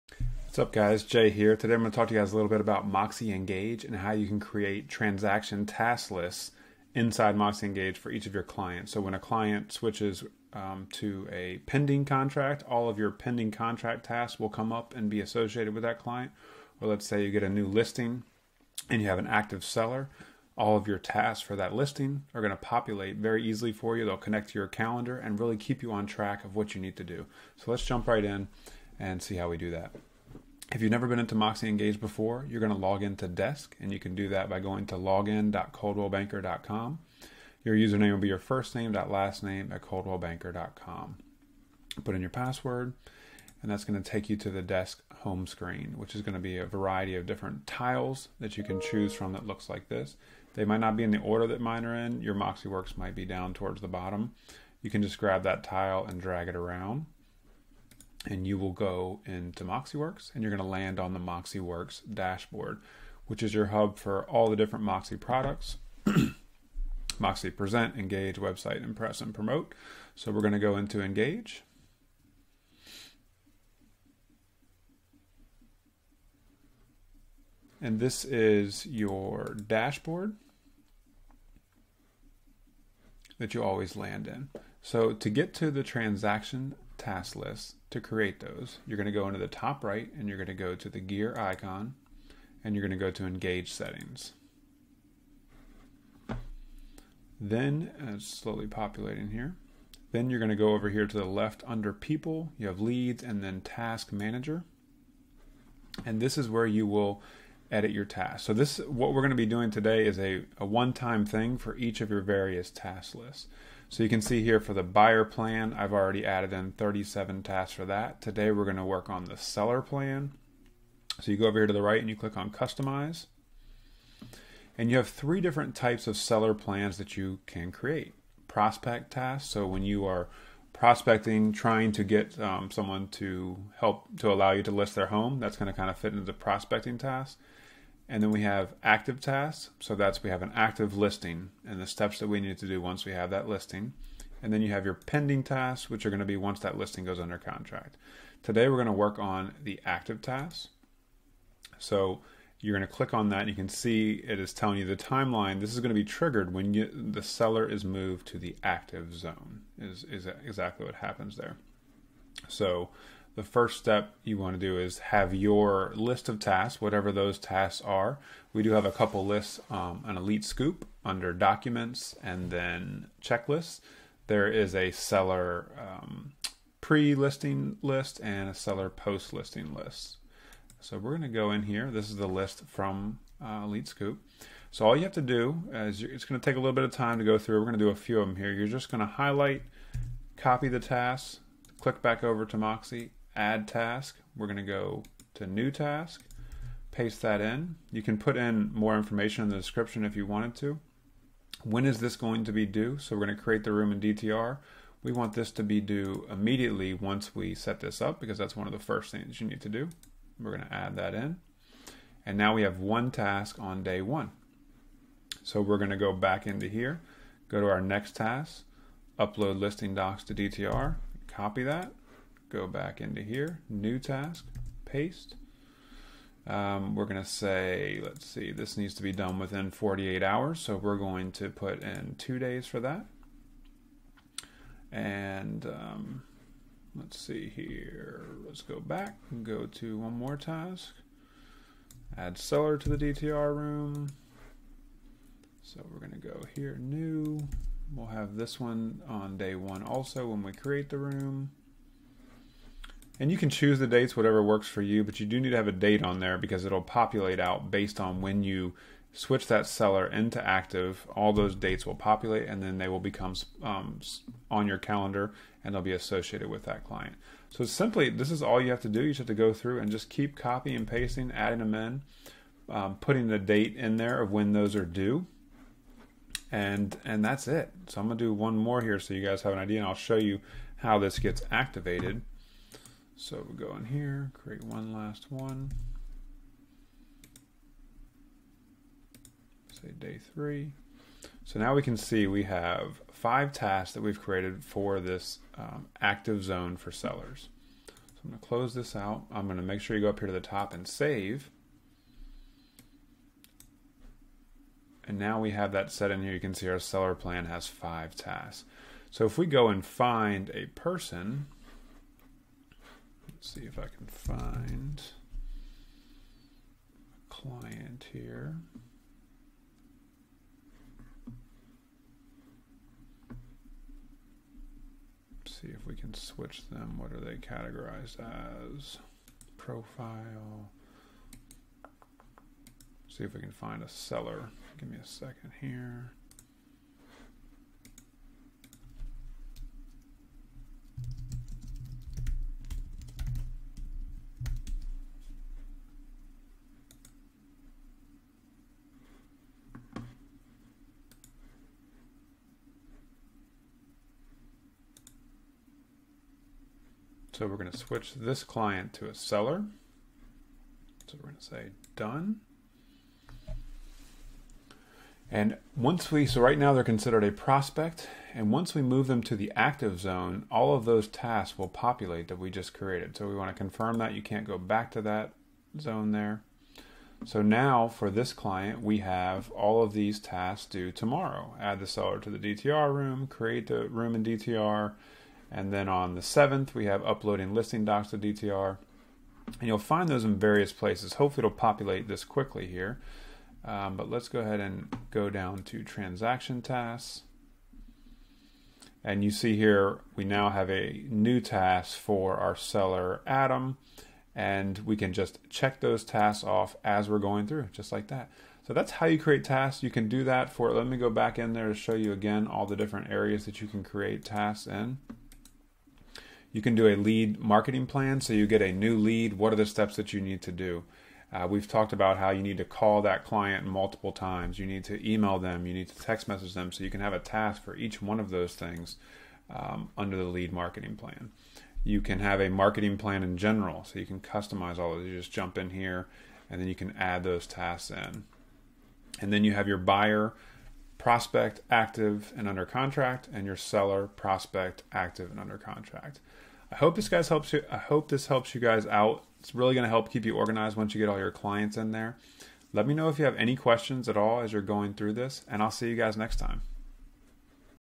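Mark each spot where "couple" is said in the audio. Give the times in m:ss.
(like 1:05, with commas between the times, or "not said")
2:48.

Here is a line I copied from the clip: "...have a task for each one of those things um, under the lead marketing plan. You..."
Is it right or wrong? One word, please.
right.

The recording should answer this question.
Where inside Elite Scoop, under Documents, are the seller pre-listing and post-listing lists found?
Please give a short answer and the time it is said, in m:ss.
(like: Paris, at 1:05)
Checklists, at 2:53.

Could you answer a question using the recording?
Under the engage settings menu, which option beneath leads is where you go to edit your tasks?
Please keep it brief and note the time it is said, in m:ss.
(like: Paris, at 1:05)
Task manager, at 1:43.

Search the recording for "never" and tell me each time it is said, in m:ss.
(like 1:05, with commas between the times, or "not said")
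0:30.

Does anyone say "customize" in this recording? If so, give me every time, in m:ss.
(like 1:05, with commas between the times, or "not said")
2:02, 7:14.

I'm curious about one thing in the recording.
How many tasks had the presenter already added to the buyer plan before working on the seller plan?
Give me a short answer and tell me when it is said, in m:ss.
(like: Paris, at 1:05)
37, at 1:56.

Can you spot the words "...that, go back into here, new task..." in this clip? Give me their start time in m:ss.
3:41.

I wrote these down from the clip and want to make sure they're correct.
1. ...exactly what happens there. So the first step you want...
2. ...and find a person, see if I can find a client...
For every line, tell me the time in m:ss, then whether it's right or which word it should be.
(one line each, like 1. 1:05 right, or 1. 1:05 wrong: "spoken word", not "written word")
1. 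2:40 right
2. 5:09 right.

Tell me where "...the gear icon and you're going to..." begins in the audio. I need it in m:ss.
1:30.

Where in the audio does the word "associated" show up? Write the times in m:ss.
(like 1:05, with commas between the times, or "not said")
0:15, 4:25.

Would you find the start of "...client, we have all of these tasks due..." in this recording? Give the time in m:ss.
6:18.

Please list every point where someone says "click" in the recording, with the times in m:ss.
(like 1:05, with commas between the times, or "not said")
2:02, 2:32, 3:11.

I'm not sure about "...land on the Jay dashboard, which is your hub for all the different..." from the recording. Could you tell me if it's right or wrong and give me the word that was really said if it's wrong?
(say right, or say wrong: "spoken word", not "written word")
wrong: "MoxieWorks", not "Jay".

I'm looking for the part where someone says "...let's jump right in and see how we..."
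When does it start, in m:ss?
0:27.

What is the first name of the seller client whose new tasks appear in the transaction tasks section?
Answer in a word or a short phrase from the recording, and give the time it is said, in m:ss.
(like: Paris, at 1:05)
Adam, at 6:43.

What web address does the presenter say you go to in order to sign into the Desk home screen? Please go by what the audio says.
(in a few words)
login.coldwellbanker.com.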